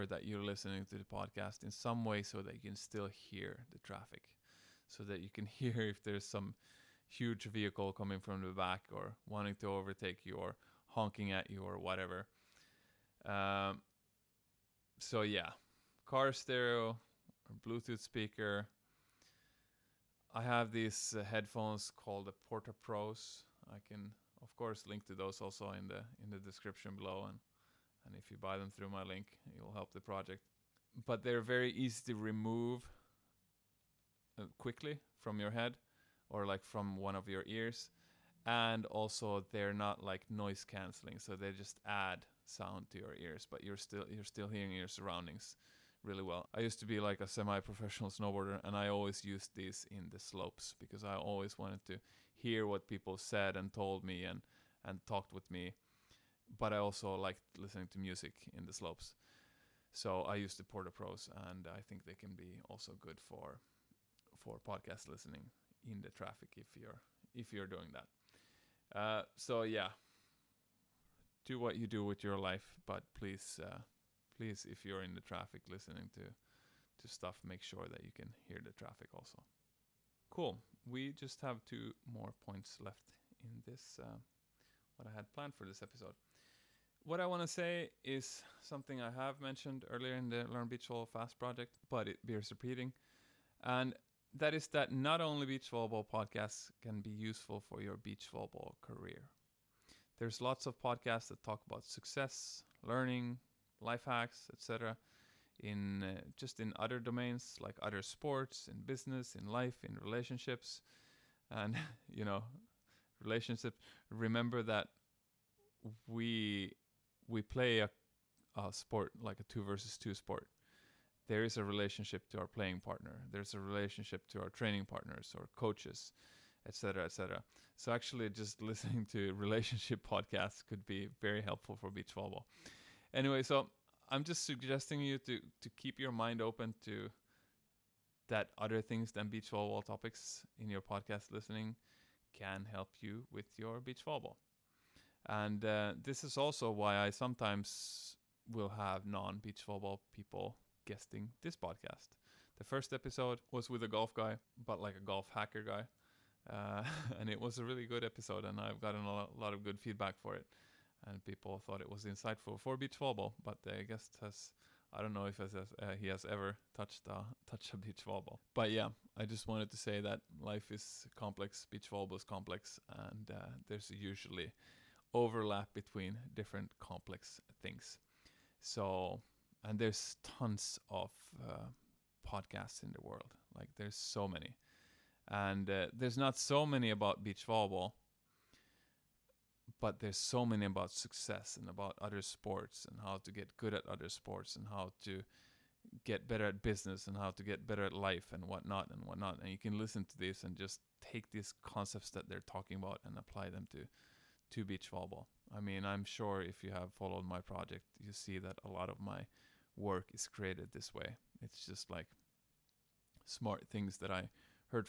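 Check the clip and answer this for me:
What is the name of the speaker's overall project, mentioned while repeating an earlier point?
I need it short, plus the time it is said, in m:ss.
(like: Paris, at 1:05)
Learn Beach Volleyball Fast, at 1:30.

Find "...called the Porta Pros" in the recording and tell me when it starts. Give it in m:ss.
0:21.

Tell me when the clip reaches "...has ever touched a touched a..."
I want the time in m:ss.
2:46.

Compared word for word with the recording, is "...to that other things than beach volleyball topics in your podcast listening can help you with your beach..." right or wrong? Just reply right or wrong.
right.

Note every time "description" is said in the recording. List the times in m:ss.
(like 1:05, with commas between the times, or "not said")
0:26.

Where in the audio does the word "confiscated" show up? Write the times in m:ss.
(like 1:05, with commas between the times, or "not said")
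not said.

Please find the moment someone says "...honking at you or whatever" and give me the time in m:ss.
0:10.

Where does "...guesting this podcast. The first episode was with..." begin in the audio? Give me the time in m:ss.
2:30.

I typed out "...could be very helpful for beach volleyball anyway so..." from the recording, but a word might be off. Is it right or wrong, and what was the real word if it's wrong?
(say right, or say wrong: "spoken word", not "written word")
right.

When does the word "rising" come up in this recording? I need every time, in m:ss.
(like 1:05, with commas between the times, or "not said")
not said.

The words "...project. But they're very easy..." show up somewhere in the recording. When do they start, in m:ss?
0:30.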